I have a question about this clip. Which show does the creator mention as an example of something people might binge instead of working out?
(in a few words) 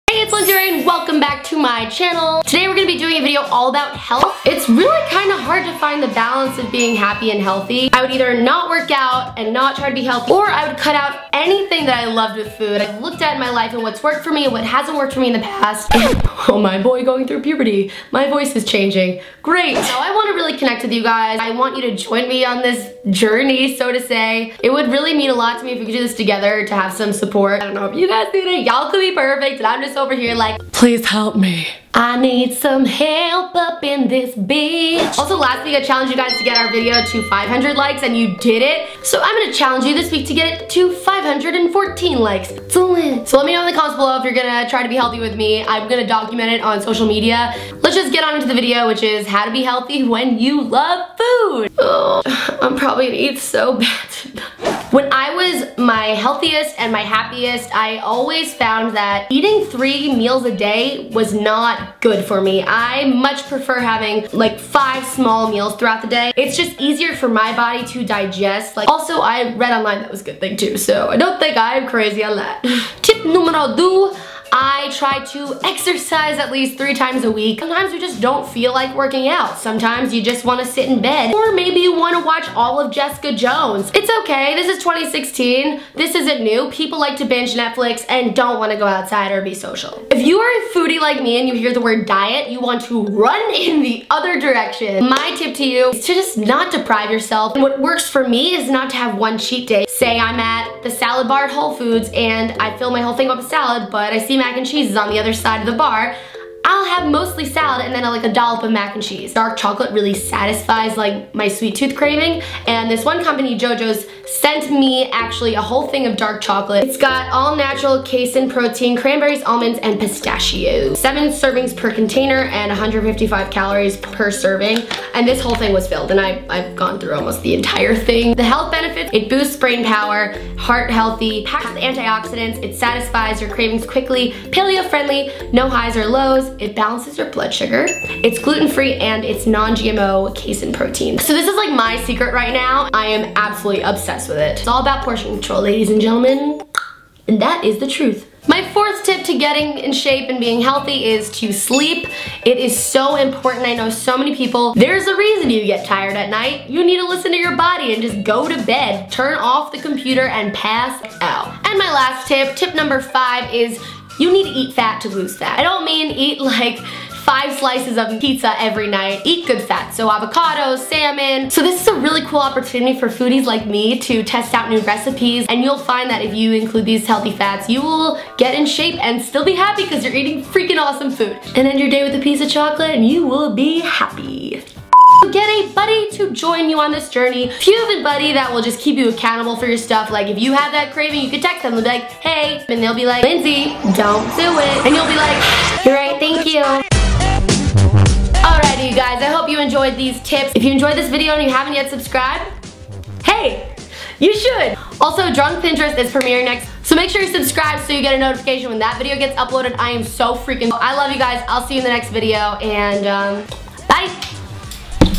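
Jessica Jones.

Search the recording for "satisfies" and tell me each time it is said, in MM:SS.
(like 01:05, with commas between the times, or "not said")
01:50, 02:12.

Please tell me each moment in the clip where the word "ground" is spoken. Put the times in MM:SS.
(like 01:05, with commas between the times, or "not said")
not said.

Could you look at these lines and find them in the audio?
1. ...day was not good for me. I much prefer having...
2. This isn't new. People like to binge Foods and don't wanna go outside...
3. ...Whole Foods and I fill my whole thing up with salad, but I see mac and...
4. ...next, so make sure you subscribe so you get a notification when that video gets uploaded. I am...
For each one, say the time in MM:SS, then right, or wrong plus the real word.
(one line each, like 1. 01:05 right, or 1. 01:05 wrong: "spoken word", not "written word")
1. 01:00 right
2. 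01:25 wrong: "Netflix", not "Foods"
3. 01:41 right
4. 03:26 right.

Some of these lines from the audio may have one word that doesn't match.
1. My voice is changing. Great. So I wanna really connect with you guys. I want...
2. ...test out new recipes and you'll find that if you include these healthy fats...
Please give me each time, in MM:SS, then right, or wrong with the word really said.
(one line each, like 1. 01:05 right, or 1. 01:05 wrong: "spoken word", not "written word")
1. 00:18 right
2. 02:54 right.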